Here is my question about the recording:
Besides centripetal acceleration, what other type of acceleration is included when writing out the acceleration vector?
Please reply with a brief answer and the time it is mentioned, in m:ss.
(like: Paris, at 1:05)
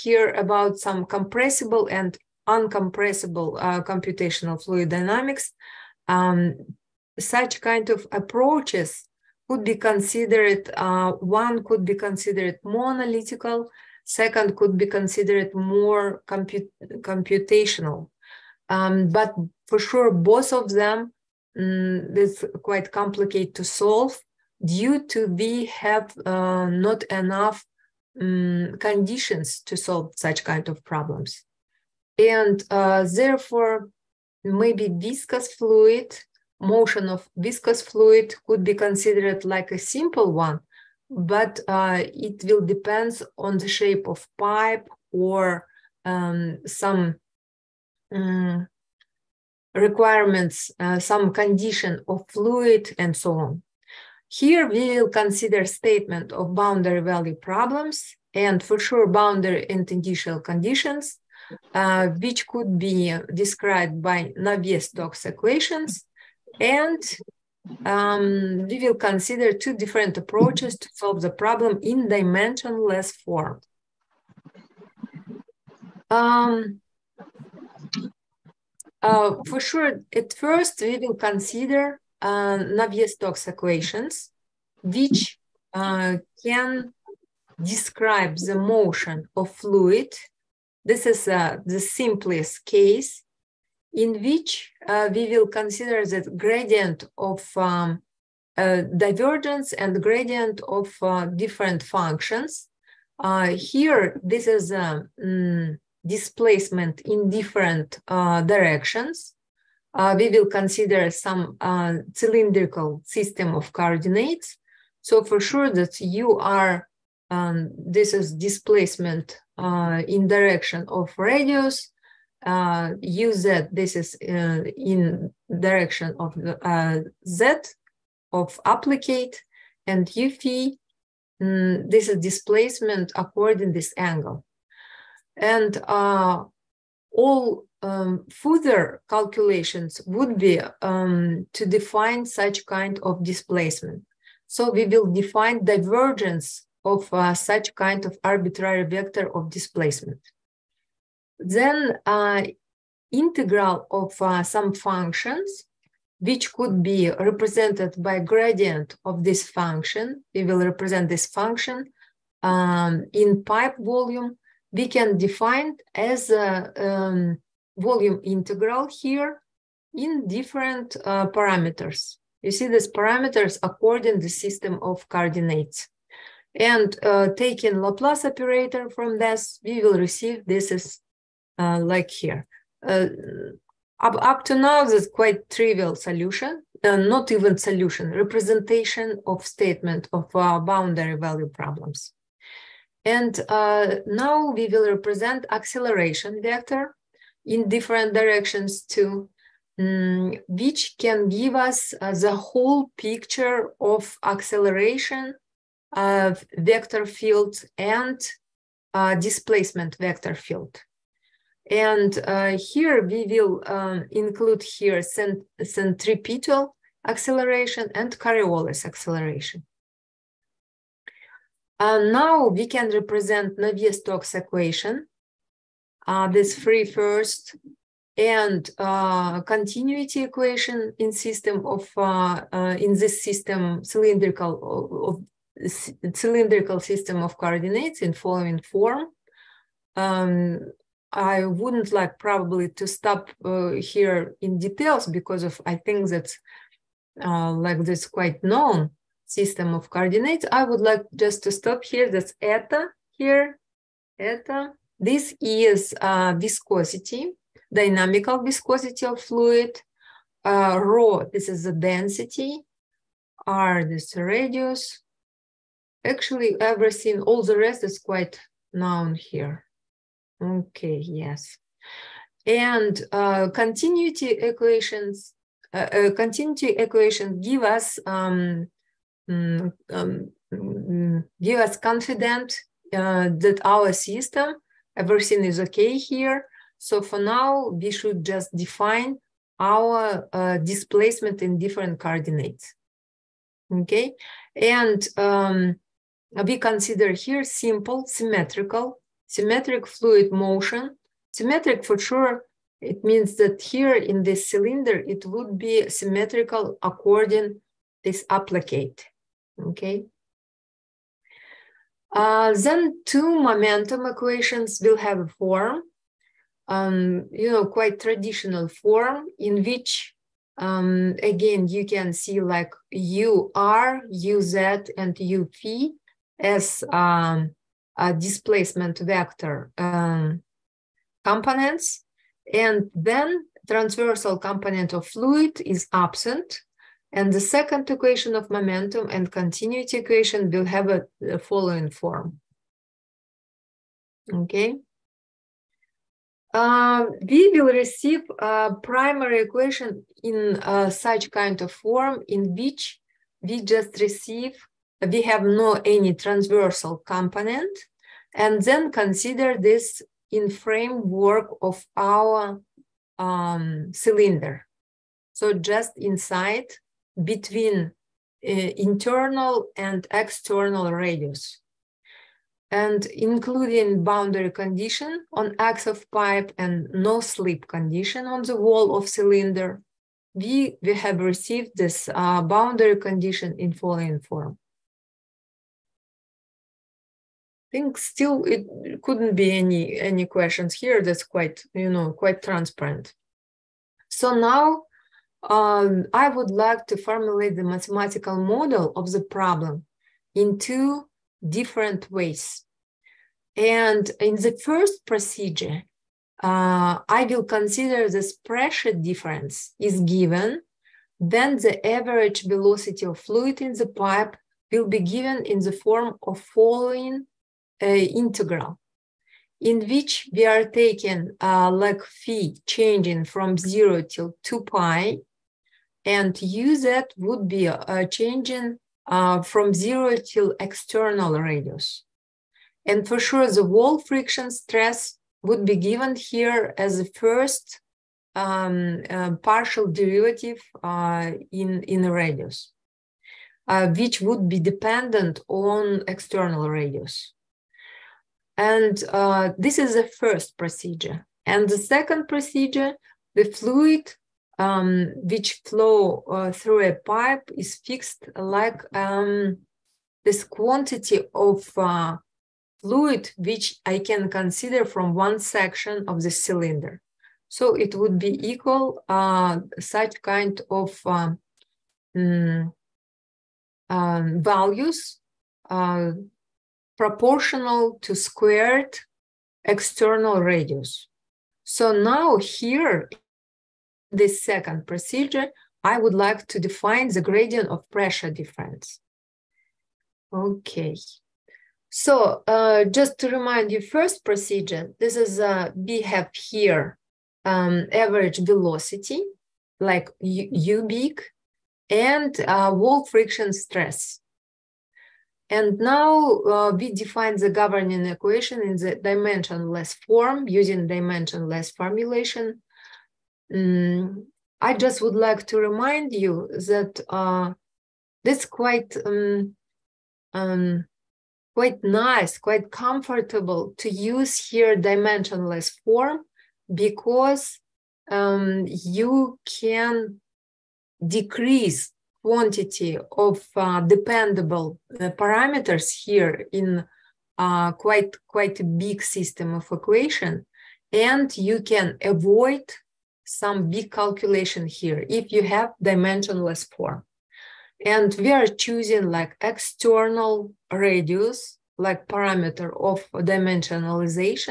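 Coriolis acceleration, at 3:38.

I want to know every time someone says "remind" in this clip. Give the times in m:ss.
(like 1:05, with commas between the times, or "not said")
8:13, 8:35.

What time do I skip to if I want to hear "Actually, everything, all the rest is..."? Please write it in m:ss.
4:26.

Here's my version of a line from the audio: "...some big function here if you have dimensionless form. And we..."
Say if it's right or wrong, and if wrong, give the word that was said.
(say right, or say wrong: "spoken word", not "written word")
wrong: "calculation", not "function".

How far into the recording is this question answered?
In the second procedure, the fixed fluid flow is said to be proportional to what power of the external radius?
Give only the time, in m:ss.
7:58.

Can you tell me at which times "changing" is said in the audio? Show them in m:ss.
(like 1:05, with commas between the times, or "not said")
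7:02, 7:08.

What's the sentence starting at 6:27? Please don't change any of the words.
I think still it couldn't be any any questions here.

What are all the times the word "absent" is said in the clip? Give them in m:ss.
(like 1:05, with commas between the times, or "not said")
5:35.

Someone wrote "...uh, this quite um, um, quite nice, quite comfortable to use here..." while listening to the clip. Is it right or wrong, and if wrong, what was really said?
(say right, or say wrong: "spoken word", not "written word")
right.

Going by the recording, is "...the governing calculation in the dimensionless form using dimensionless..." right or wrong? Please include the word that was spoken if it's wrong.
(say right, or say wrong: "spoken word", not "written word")
wrong: "equation", not "calculation".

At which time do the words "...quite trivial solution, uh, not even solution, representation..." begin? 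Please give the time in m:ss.
3:05.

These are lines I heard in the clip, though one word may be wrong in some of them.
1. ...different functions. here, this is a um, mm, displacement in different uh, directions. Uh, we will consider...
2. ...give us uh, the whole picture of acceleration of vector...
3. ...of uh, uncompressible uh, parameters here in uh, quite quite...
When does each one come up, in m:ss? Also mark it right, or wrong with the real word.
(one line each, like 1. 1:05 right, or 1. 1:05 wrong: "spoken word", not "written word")
1. 1:41 right
2. 3:21 right
3. 8:53 wrong: "dependable", not "uncompressible".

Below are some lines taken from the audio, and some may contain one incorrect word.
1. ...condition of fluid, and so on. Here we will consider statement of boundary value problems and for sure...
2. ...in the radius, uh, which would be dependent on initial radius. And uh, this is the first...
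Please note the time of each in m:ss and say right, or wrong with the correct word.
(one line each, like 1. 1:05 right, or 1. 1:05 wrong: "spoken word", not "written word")
1. 0:51 right
2. 7:21 wrong: "external", not "initial".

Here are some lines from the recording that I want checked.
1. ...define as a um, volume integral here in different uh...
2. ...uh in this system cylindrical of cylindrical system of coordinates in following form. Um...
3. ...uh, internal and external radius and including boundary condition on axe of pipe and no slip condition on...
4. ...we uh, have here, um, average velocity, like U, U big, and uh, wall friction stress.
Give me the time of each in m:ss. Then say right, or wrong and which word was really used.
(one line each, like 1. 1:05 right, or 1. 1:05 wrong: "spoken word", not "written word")
1. 2:45 right
2. 3:52 right
3. 6:08 right
4. 8:15 right.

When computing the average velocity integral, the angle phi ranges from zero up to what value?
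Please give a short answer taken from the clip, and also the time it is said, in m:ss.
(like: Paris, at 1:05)
2 pi, at 7:04.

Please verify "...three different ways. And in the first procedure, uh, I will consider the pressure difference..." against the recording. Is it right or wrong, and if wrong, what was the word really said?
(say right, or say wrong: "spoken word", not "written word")
wrong: "two", not "three".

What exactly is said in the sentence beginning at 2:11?
Mm, this is displacement according this angle and uh, all um, further calculations would be um, to define such kind of displacement.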